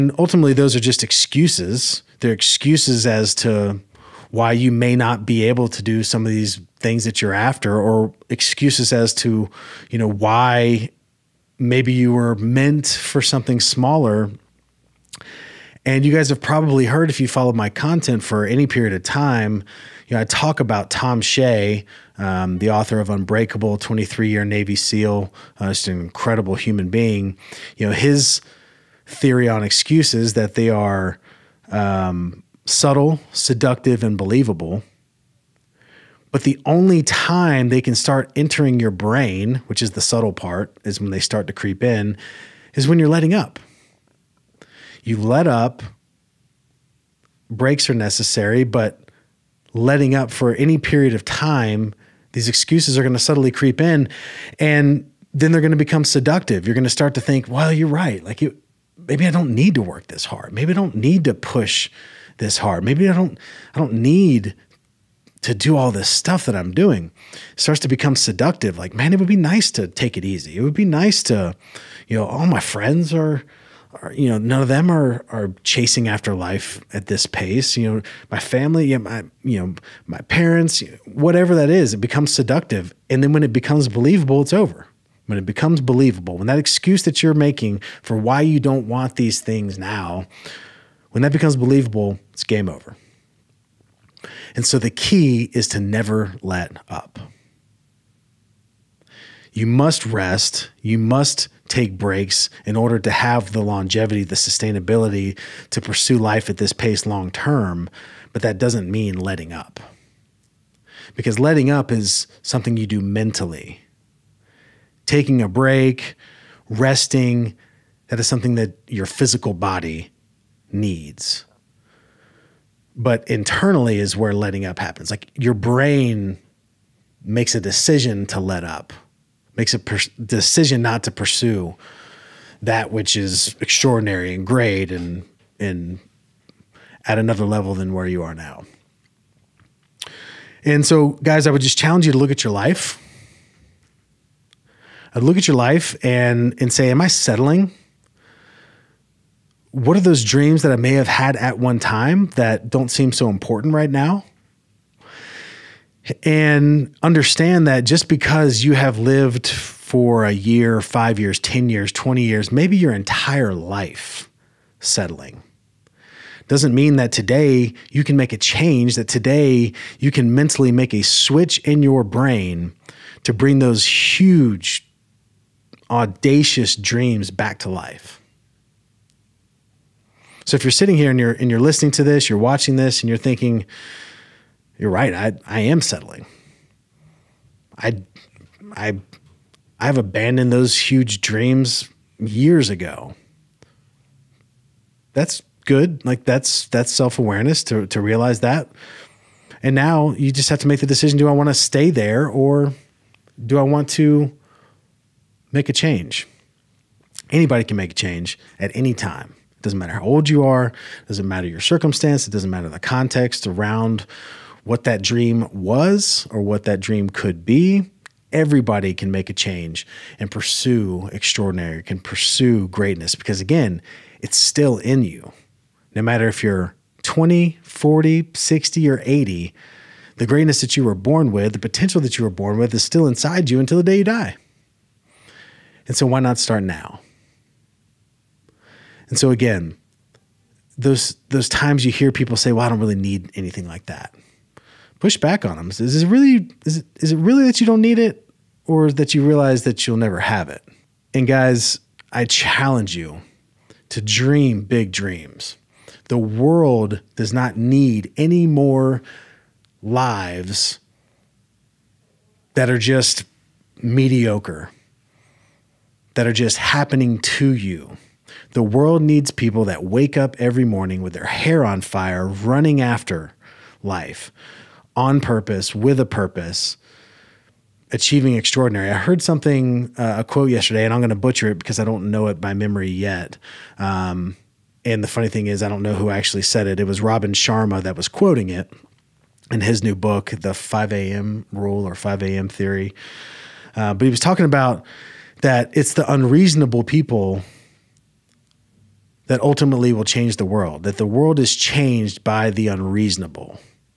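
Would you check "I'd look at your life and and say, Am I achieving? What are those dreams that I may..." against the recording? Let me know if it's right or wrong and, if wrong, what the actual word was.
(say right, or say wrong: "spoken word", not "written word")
wrong: "settling", not "achieving".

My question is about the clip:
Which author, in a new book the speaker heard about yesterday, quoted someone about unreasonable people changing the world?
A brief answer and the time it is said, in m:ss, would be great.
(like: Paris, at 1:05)
Robin Sharma, at 4:47.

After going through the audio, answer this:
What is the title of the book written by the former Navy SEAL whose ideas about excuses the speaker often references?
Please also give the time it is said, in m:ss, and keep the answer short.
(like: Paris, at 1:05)
Unbreakable, at 0:23.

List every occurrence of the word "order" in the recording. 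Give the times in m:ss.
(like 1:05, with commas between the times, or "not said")
1:42.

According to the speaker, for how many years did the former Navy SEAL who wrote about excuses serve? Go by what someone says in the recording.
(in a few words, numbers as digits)
23.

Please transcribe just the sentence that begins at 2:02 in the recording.
But internally is where letting up happens.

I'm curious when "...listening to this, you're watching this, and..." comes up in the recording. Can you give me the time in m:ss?
3:01.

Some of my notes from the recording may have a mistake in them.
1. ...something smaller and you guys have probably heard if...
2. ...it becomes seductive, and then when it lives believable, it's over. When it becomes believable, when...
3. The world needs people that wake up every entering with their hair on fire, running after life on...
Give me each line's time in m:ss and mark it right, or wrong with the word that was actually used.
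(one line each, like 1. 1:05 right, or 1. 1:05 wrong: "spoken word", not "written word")
1. 0:13 right
2. 1:21 wrong: "becomes", not "lives"
3. 4:28 wrong: "morning", not "entering".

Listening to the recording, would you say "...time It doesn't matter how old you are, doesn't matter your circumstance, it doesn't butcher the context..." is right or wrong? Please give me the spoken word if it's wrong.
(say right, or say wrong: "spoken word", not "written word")
wrong: "matter", not "butcher".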